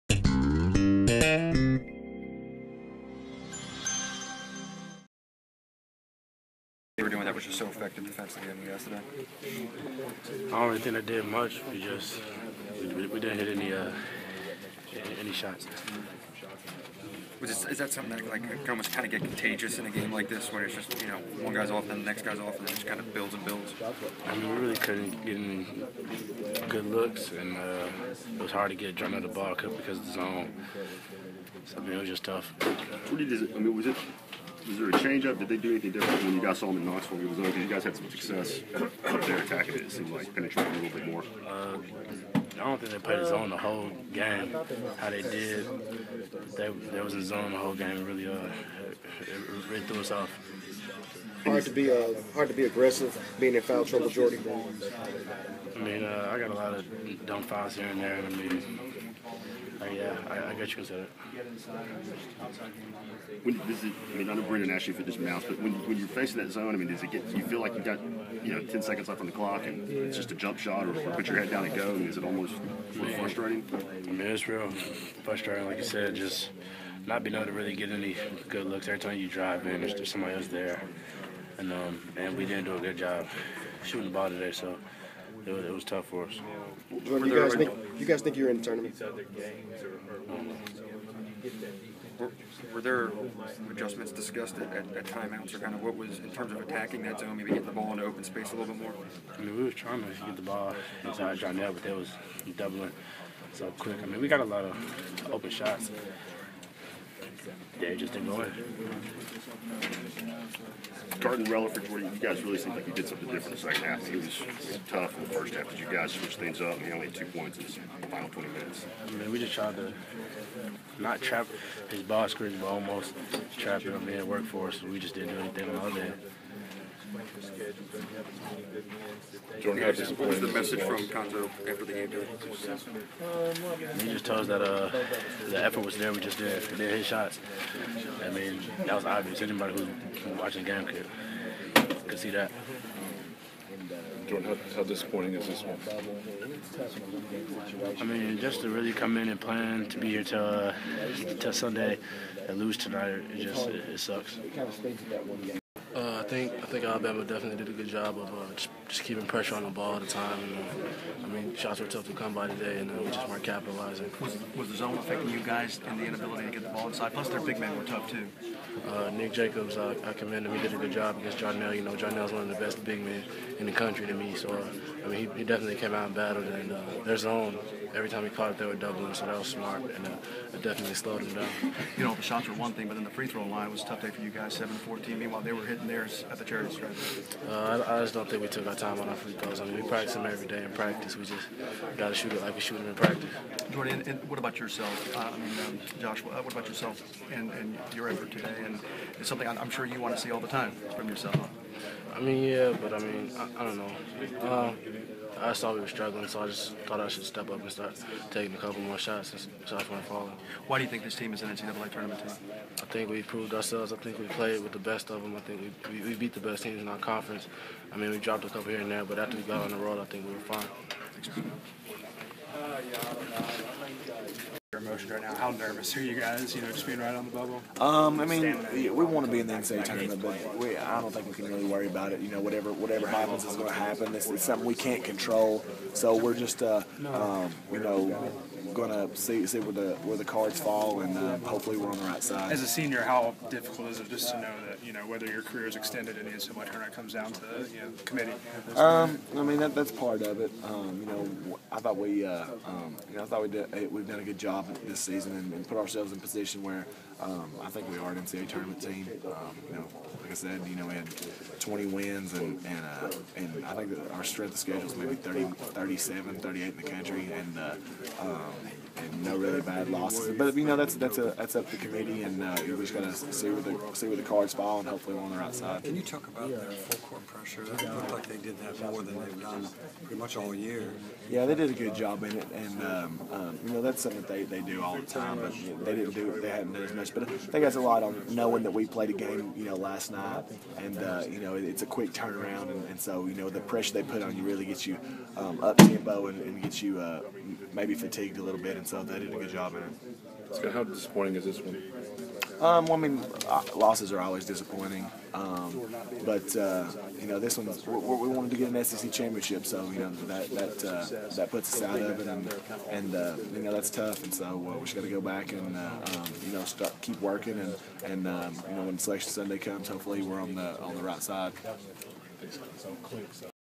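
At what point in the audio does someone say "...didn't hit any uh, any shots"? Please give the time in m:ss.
0:13.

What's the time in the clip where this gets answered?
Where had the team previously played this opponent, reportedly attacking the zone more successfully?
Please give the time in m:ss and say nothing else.
0:36.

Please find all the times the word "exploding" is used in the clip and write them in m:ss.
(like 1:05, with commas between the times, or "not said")
not said.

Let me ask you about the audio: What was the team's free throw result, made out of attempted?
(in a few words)
7 of 14.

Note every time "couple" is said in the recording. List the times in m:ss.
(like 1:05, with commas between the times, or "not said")
3:28, 3:38.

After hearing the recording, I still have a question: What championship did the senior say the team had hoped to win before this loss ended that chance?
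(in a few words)
SEC championship.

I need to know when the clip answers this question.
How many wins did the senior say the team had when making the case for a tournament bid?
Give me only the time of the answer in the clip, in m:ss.
4:21.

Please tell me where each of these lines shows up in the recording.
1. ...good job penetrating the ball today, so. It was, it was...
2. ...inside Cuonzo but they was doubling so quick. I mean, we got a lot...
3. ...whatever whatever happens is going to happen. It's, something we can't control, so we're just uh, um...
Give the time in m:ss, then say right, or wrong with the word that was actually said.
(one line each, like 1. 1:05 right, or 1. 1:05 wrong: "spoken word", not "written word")
1. 1:22 wrong: "shooting", not "penetrating"
2. 1:41 wrong: "John", not "Cuonzo"
3. 3:52 right.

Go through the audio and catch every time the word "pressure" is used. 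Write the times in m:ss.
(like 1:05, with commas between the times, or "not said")
2:39, 4:37, 4:53.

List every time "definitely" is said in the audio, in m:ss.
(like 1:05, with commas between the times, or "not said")
2:37, 2:55, 3:00.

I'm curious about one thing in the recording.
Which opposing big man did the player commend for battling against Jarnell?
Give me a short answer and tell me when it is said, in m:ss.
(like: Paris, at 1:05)
Nick Jacobs, at 2:49.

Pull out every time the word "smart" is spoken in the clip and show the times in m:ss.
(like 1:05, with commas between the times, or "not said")
2:59.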